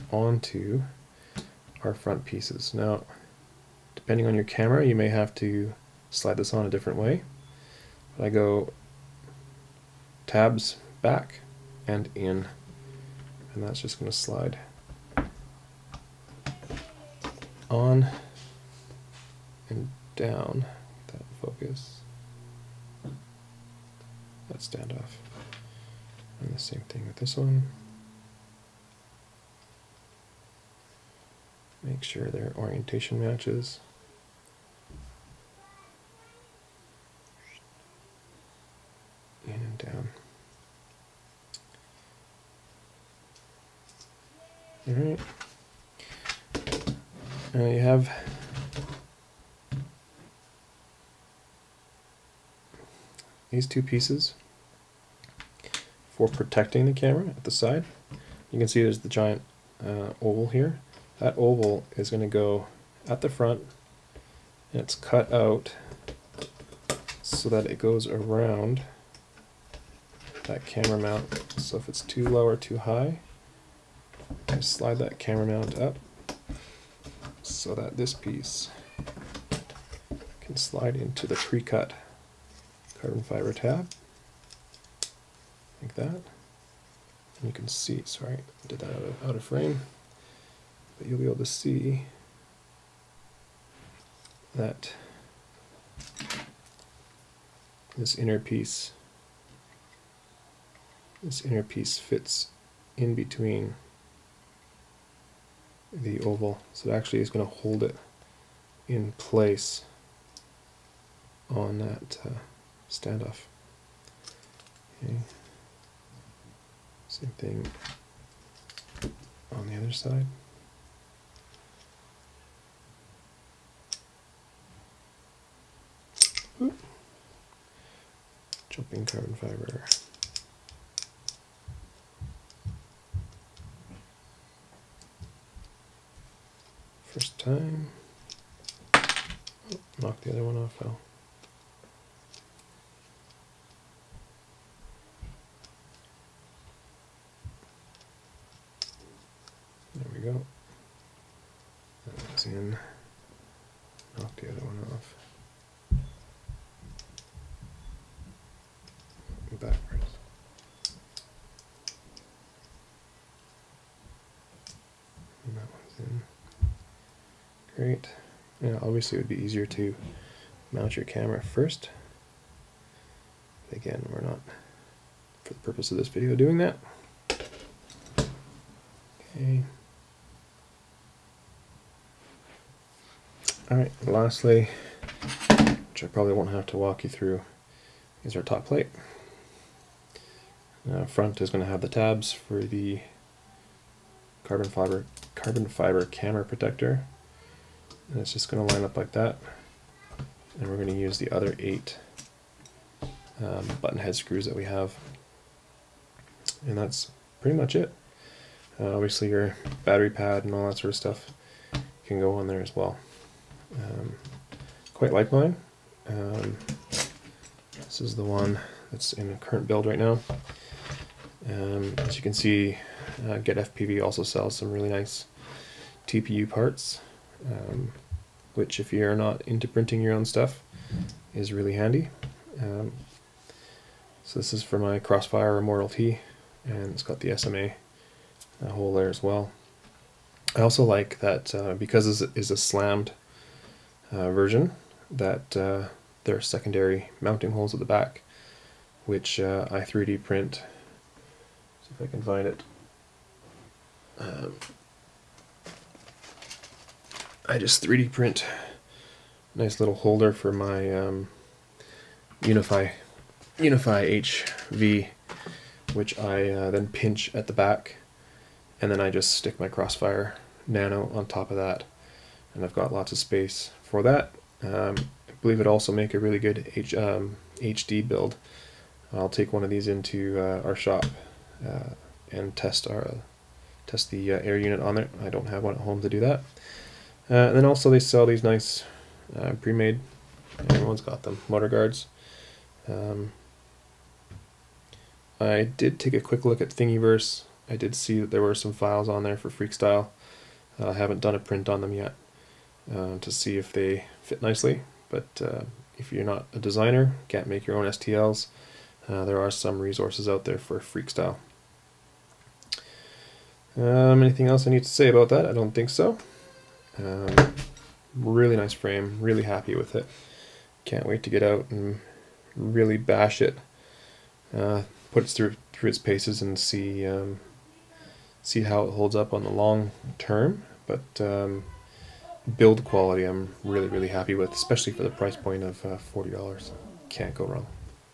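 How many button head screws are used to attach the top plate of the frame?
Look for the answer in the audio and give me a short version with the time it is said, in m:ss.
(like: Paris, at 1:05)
8, at 3:21.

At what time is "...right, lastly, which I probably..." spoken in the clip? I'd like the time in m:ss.
3:03.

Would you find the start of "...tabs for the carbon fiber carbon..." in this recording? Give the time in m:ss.
3:11.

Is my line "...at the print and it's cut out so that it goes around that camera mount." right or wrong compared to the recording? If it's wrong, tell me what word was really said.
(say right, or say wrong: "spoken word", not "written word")
wrong: "front", not "print".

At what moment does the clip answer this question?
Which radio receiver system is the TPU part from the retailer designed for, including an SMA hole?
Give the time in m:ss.
3:54.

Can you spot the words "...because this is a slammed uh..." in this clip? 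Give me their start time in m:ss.
4:01.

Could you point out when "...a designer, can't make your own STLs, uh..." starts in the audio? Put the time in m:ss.
5:06.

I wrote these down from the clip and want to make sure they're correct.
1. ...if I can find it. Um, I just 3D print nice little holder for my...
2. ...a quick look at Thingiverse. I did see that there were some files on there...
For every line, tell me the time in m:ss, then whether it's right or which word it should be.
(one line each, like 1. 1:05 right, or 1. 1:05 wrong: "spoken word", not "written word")
1. 4:12 right
2. 4:56 right.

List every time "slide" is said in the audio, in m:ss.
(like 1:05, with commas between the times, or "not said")
0:06, 0:14, 1:14, 1:20.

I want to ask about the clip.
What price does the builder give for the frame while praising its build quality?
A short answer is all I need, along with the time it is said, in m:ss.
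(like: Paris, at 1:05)
$40, at 5:35.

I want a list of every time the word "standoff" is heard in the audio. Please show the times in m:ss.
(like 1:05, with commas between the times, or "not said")
0:24, 1:52.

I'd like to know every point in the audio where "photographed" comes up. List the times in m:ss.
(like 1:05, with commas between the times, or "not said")
not said.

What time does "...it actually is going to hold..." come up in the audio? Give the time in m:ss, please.
1:46.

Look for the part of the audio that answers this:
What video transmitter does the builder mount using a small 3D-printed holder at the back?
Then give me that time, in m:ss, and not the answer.
4:23.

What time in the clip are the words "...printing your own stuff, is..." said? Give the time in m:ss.
3:49.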